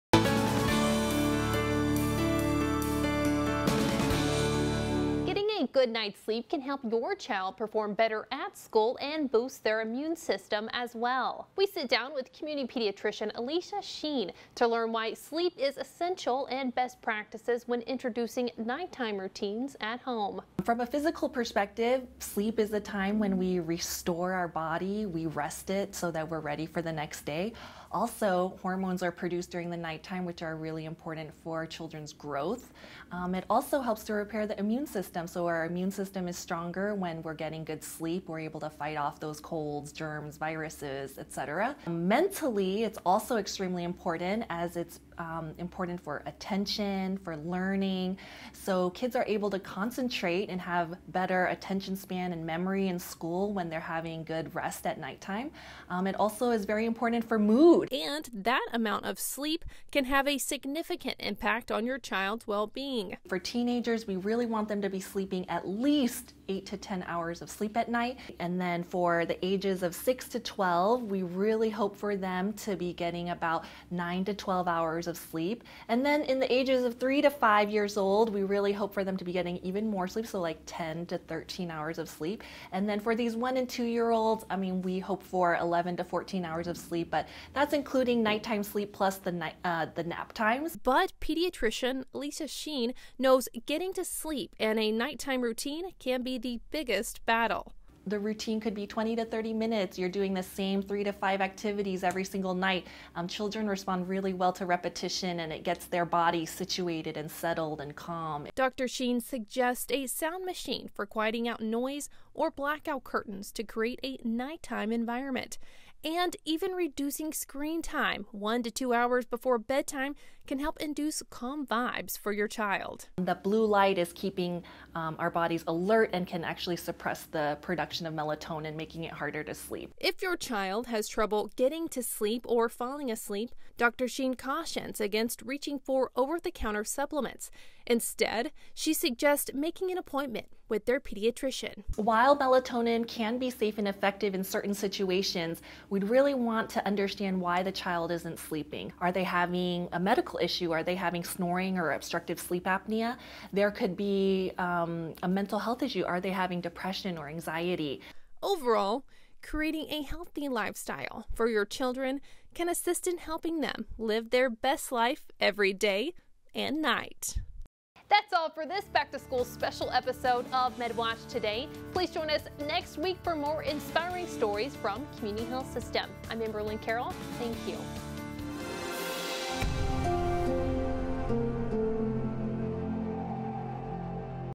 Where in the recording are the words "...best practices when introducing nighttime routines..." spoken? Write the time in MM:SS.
00:16.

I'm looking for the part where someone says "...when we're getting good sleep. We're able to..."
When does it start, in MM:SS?
00:36.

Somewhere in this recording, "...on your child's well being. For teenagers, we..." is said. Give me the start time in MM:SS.
01:01.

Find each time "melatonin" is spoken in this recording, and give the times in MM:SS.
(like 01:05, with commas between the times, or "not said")
02:08, 02:22.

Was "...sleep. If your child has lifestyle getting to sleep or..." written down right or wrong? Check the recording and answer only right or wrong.
wrong.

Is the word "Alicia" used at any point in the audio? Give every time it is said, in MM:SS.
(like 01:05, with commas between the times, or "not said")
00:13, 01:32.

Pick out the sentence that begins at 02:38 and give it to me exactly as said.
Overall, creating a healthy lifestyle for your children can assist in helping them live their best life every day and night.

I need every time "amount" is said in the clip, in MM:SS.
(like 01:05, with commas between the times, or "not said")
00:58.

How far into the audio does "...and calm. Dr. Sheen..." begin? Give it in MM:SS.
01:47.